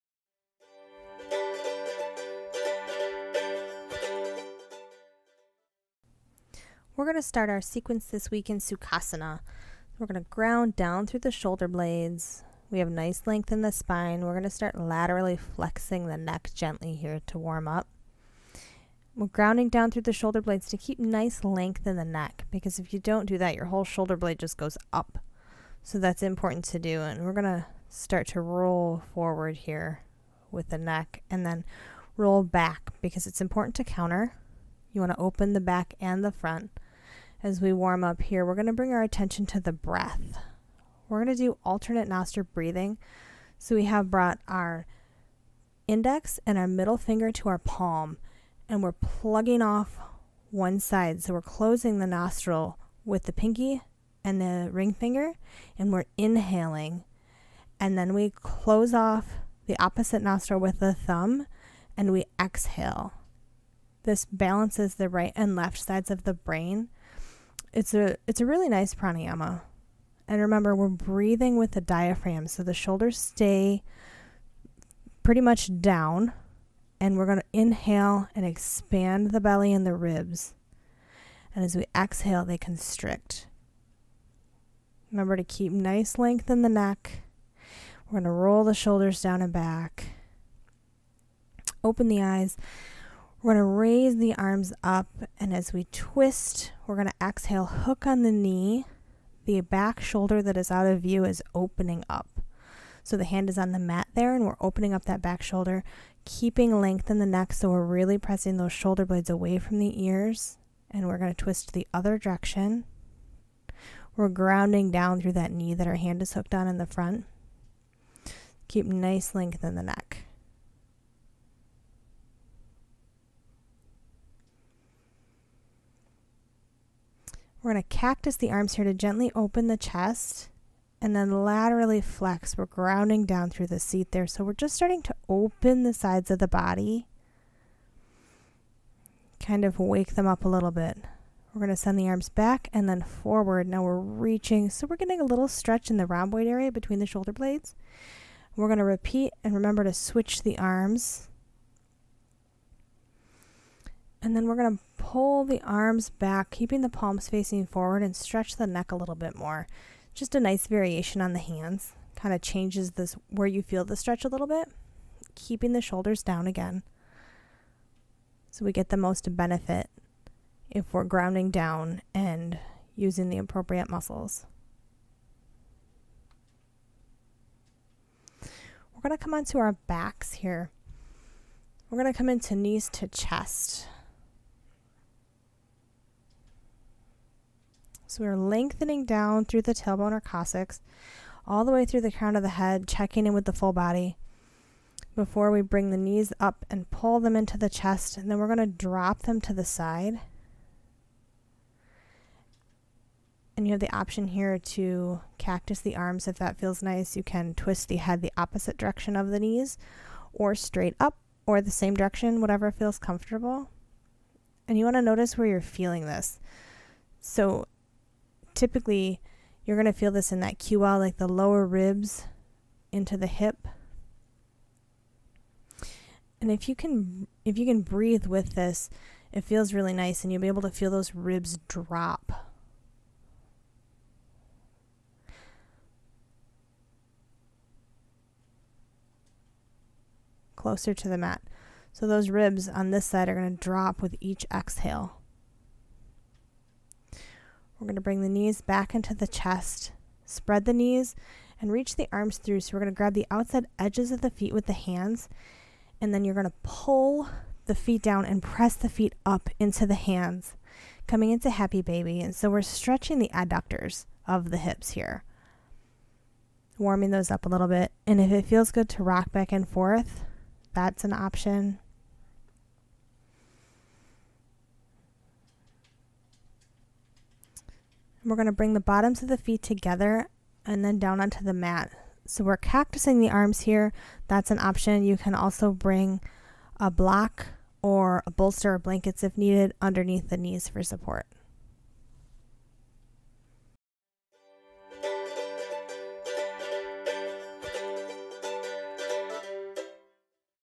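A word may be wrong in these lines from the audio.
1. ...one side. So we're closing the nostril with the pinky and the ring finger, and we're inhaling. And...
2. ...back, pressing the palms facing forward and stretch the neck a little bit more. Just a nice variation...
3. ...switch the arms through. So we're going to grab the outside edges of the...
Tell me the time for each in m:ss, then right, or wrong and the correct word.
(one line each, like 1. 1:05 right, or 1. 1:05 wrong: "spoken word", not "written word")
1. 0:50 right
2. 2:36 wrong: "keeping", not "pressing"
3. 4:11 wrong: "reach", not "switch".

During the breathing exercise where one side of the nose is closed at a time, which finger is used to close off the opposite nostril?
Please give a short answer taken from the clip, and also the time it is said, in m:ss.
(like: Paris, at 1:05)
The thumb, at 1:00.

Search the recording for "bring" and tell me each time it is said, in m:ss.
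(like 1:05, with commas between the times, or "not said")
0:38, 3:15, 4:08, 4:38, 4:45.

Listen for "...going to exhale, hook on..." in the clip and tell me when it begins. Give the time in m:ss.
1:36.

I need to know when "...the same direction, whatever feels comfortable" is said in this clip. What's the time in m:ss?
3:31.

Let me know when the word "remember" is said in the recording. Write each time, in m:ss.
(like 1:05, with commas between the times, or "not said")
1:10, 1:25, 2:29.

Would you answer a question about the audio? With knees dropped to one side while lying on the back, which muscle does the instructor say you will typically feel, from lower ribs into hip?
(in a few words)
QL.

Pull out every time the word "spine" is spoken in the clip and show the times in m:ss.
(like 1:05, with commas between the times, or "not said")
0:13.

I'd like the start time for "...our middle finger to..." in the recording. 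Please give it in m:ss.
0:46.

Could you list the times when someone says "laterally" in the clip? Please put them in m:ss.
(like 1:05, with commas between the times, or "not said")
0:14, 2:11.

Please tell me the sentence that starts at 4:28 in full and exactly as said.
And if it feels good to rock back and forth, that's an option.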